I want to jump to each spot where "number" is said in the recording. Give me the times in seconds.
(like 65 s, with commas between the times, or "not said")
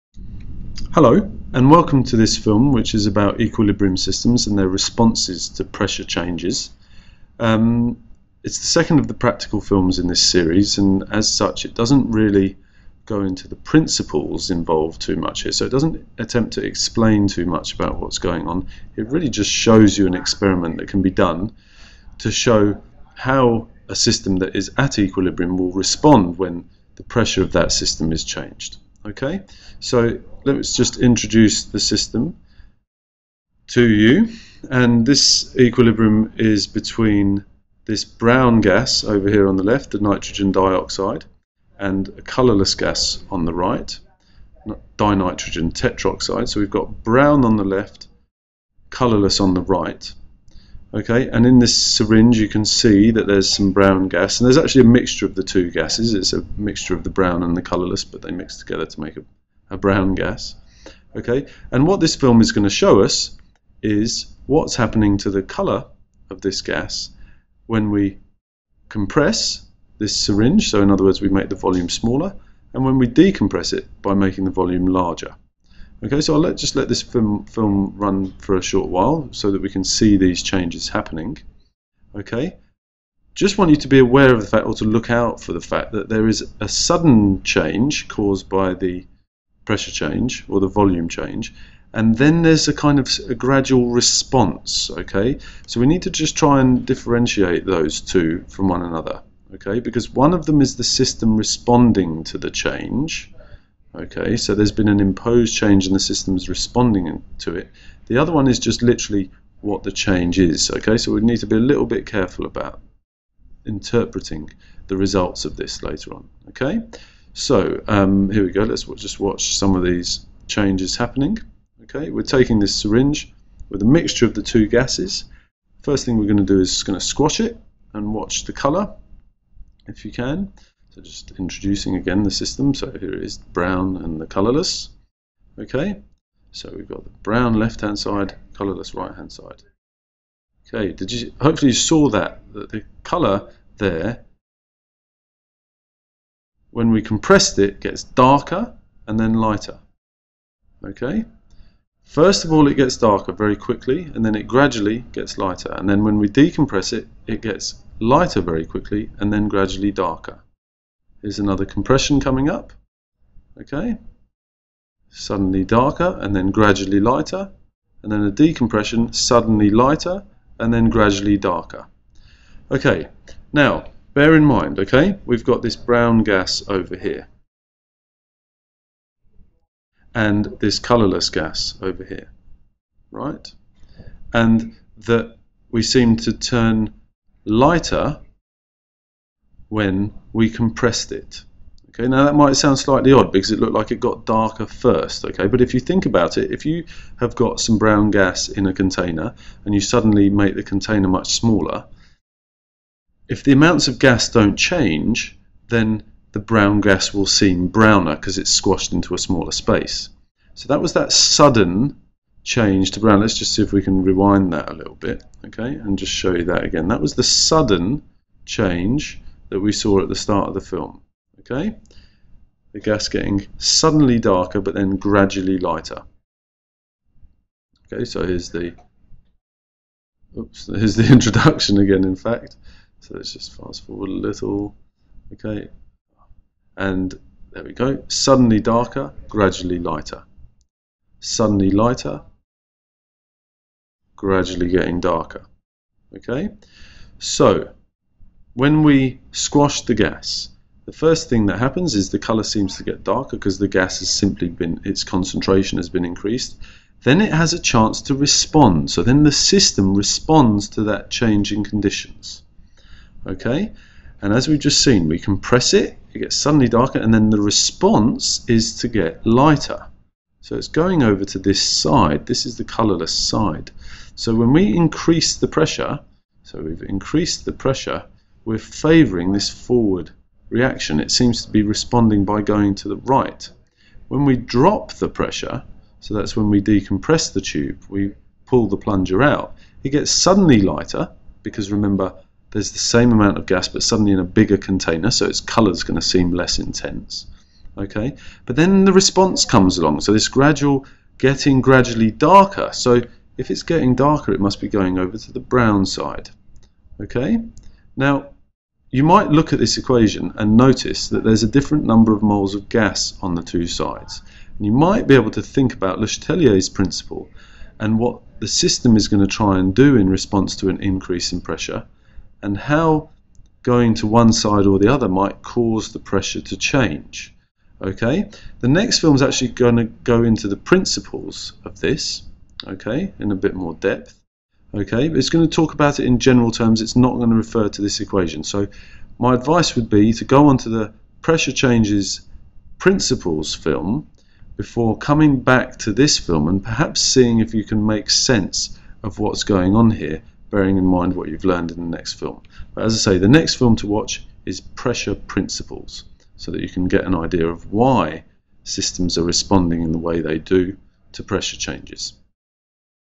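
311 s.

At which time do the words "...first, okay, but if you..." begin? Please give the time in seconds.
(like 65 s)
194 s.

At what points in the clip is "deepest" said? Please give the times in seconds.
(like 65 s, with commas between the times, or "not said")
not said.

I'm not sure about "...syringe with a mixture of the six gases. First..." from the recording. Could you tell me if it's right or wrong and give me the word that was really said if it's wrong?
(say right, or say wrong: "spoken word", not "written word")
wrong: "two", not "six".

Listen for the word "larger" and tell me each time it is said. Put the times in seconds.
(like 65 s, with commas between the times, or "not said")
74 s.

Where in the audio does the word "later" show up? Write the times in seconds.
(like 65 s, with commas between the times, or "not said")
115 s.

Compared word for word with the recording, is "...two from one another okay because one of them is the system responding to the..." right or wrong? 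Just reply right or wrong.
right.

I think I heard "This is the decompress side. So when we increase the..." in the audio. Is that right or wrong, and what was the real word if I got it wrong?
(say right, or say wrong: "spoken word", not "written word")
wrong: "colorless", not "decompress".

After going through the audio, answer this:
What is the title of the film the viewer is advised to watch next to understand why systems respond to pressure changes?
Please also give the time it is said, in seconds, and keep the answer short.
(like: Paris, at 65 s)
Pressure Principles, at 354 s.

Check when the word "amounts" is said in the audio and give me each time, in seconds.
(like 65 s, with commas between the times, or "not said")
203 s, 293 s.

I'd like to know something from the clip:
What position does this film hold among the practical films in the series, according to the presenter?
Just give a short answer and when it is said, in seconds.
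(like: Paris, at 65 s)
the second, at 8 s.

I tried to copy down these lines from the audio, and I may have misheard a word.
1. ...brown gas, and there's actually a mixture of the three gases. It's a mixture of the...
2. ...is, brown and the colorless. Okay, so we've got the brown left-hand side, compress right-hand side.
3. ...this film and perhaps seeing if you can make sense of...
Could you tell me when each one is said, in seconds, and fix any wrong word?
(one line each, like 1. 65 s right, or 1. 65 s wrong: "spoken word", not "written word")
1. 53 s wrong: "two", not "three"
2. 133 s wrong: "colorless", not "compress"
3. 345 s right.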